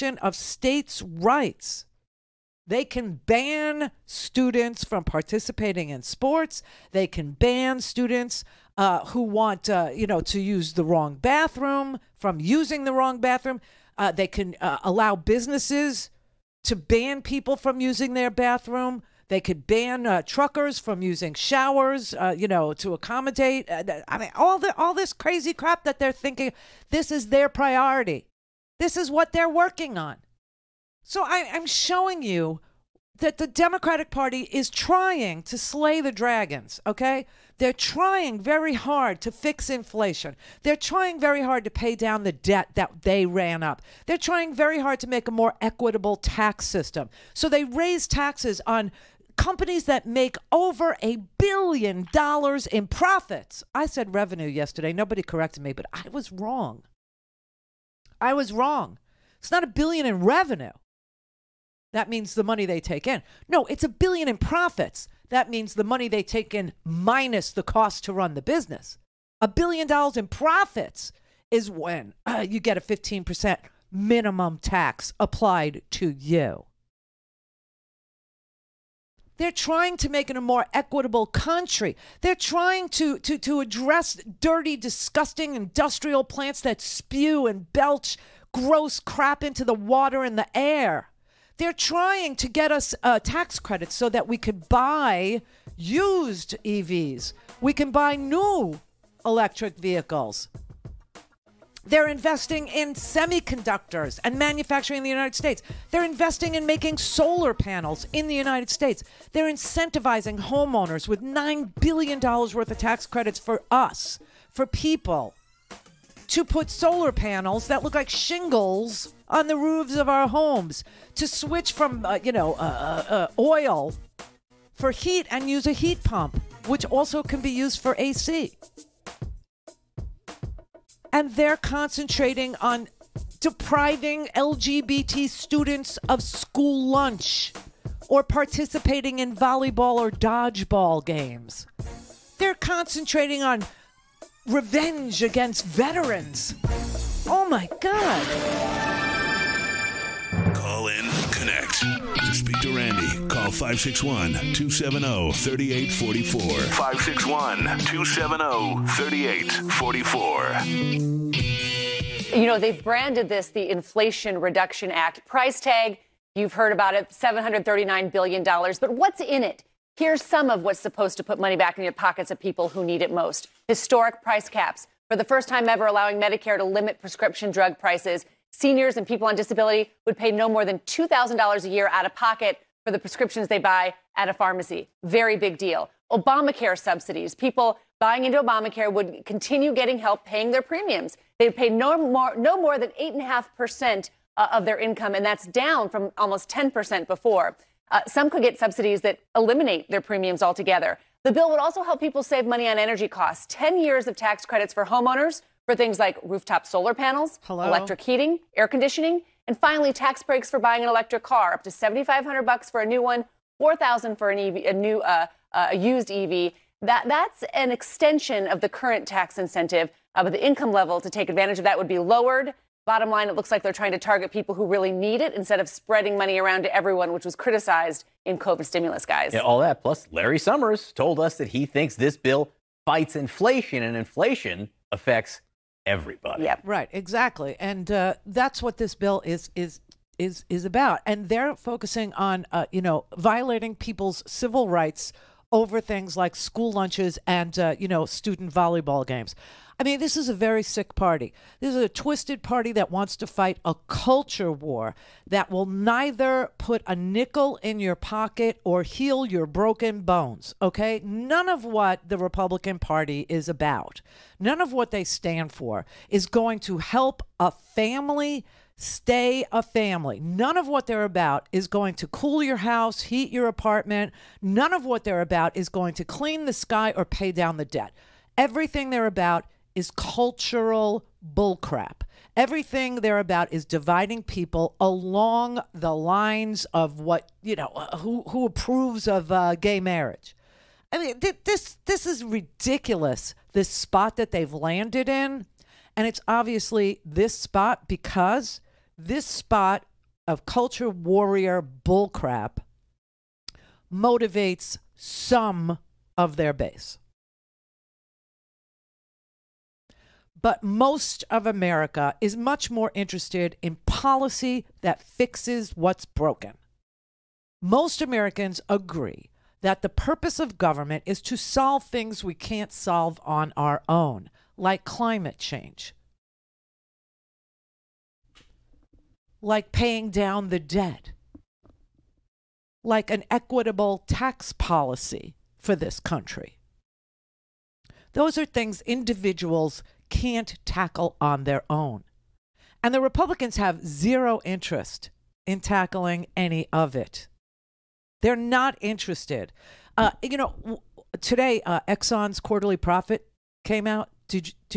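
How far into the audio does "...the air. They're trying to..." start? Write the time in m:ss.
1:30.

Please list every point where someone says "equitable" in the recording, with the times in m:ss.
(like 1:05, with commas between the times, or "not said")
0:45, 1:20, 5:33.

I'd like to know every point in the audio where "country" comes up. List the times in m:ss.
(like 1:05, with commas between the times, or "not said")
1:21, 5:36.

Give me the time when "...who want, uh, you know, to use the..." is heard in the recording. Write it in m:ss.
0:09.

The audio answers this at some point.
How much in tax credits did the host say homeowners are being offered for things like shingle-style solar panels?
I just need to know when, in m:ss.
1:51.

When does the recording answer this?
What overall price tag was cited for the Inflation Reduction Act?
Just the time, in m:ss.
2:47.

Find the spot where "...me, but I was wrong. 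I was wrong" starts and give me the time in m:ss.
0:55.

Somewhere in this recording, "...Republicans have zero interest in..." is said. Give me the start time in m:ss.
5:43.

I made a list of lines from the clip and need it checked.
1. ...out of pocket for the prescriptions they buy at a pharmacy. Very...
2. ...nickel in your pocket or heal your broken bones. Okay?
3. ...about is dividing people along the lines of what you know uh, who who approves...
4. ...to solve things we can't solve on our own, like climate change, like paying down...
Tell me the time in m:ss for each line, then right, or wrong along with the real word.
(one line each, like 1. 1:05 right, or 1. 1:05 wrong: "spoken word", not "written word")
1. 3:01 right
2. 4:16 right
3. 4:43 right
4. 5:21 right.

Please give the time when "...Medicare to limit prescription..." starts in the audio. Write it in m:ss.
2:56.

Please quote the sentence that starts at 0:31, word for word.
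So I, I'm showing you that the Democratic Party is trying to slay the dragons, okay?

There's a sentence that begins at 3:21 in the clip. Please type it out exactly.
The bill would also help people save money on energy costs.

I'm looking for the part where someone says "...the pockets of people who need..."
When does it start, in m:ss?
2:51.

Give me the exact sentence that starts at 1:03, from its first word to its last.
No, it's a billion in profits.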